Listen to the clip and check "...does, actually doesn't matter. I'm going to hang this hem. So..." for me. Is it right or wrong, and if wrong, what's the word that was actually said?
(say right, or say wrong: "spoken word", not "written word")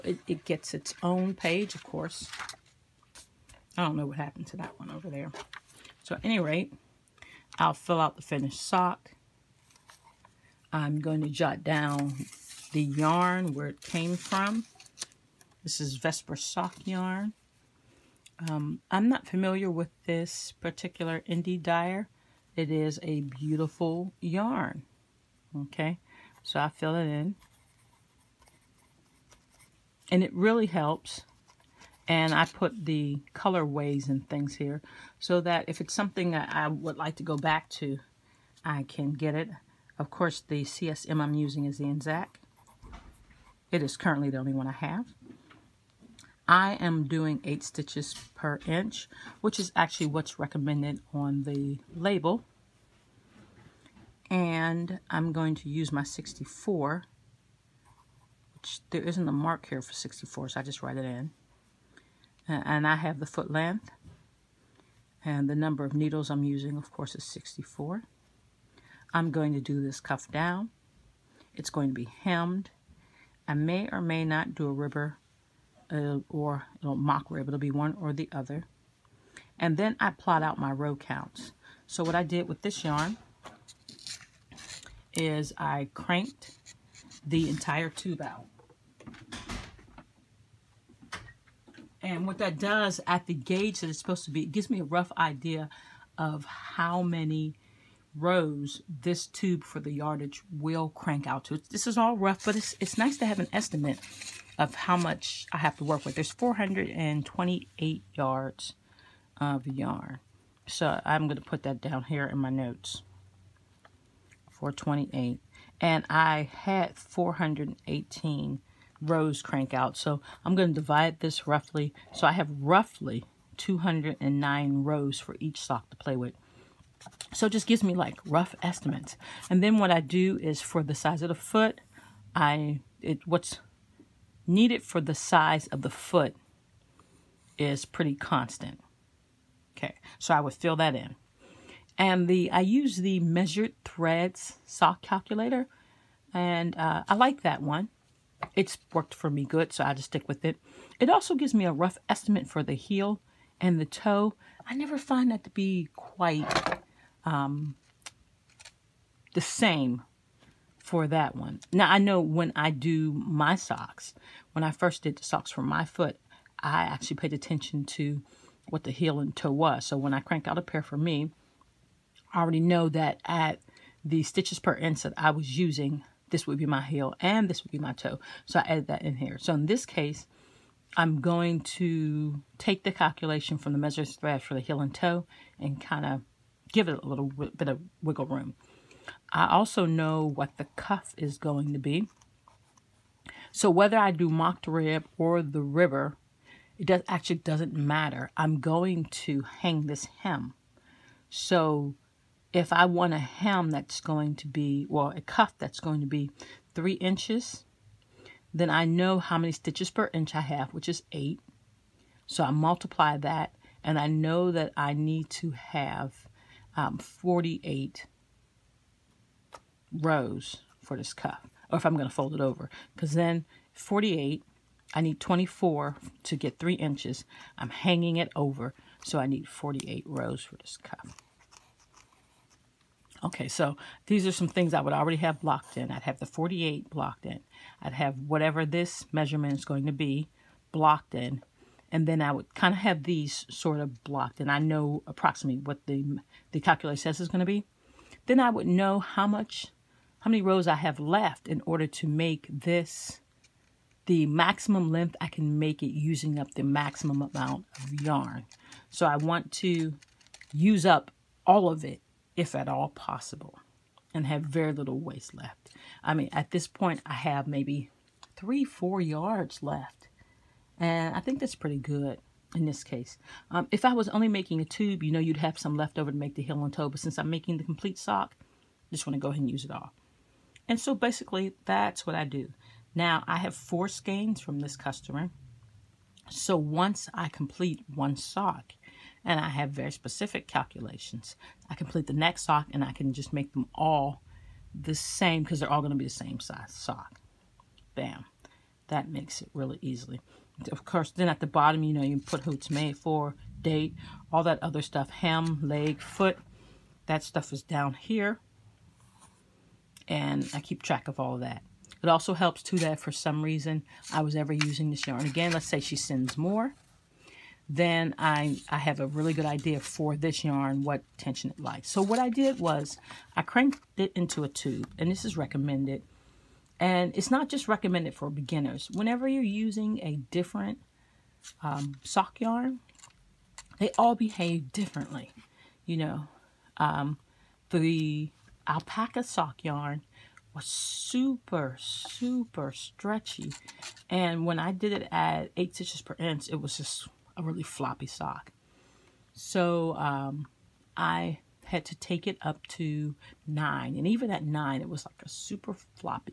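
right.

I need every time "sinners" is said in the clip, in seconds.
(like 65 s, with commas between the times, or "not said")
not said.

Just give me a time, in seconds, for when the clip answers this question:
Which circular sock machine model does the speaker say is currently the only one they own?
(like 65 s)
41 s.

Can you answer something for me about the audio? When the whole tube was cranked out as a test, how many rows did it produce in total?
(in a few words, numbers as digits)
418.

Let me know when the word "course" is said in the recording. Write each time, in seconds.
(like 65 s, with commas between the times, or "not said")
1 s, 40 s, 66 s, 300 s.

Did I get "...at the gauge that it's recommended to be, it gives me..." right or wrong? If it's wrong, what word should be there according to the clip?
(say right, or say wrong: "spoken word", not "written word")
wrong: "supposed", not "recommended".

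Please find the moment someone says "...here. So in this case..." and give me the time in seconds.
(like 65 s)
179 s.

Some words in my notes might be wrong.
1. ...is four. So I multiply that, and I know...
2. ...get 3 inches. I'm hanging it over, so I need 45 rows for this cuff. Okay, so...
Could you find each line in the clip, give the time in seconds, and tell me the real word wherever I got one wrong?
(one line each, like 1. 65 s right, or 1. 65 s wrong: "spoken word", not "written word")
1. 210 s wrong: "eight", not "four"
2. 226 s wrong: "48", not "45".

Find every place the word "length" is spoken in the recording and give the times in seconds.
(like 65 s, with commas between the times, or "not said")
63 s, 254 s.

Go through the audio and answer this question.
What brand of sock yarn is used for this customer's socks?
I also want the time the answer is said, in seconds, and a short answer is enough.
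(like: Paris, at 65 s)
Vesper, at 15 s.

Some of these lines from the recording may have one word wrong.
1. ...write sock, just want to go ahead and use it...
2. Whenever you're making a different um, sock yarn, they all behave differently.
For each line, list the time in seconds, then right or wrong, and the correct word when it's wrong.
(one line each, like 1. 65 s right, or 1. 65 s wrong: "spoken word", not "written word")
1. 277 s wrong: "complete", not "write"
2. 328 s wrong: "using", not "making".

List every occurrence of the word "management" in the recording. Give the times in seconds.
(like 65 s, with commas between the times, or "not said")
not said.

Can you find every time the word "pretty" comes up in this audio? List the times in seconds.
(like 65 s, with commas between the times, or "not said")
137 s, 271 s.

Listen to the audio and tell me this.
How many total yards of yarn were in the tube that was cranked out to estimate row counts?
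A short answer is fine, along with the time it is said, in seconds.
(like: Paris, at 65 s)
428, at 106 s.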